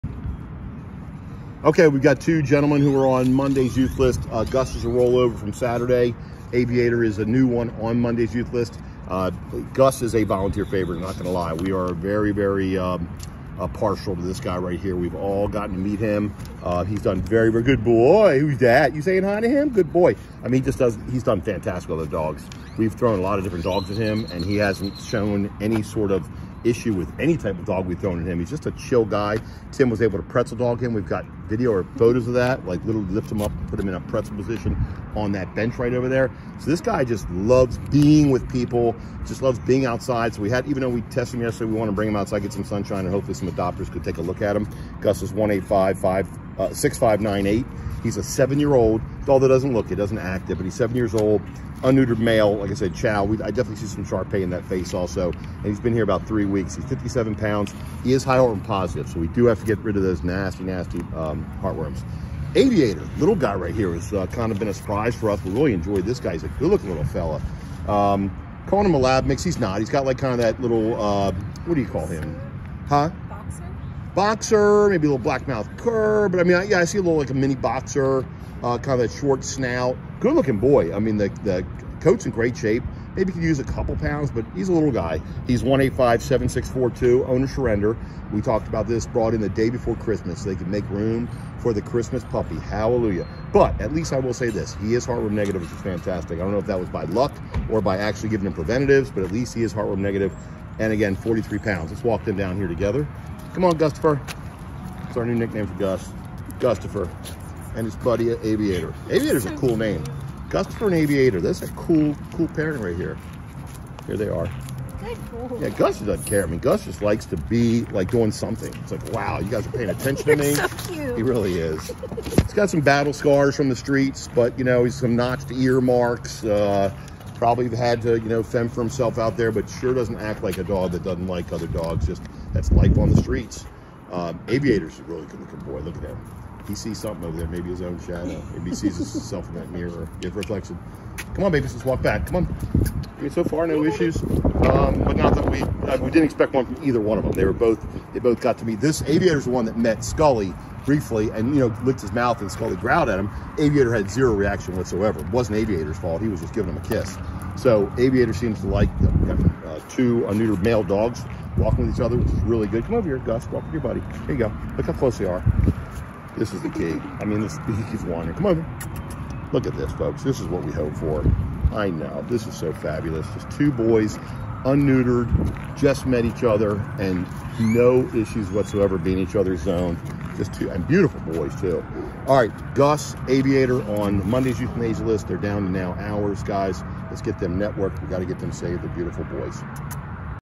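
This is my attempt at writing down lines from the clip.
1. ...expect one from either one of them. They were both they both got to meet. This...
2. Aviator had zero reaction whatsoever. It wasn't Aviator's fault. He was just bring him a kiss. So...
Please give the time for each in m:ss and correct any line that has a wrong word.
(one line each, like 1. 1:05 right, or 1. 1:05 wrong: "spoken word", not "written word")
1. 2:26 right
2. 2:33 wrong: "giving", not "bring".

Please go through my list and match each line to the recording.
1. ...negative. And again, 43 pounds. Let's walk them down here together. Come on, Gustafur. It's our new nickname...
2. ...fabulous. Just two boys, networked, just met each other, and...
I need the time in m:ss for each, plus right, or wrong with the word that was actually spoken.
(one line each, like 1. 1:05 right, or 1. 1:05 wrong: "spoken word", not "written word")
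1. 1:39 right
2. 2:52 wrong: "unneutered", not "networked".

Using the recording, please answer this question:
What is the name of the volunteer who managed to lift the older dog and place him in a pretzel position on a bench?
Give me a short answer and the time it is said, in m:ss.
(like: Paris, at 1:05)
Tim, at 0:29.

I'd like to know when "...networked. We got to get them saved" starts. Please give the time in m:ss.
3:07.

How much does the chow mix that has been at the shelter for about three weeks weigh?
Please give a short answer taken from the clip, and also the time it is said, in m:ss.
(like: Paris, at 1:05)
57 pounds, at 0:56.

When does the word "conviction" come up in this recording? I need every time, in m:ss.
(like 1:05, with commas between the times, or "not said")
not said.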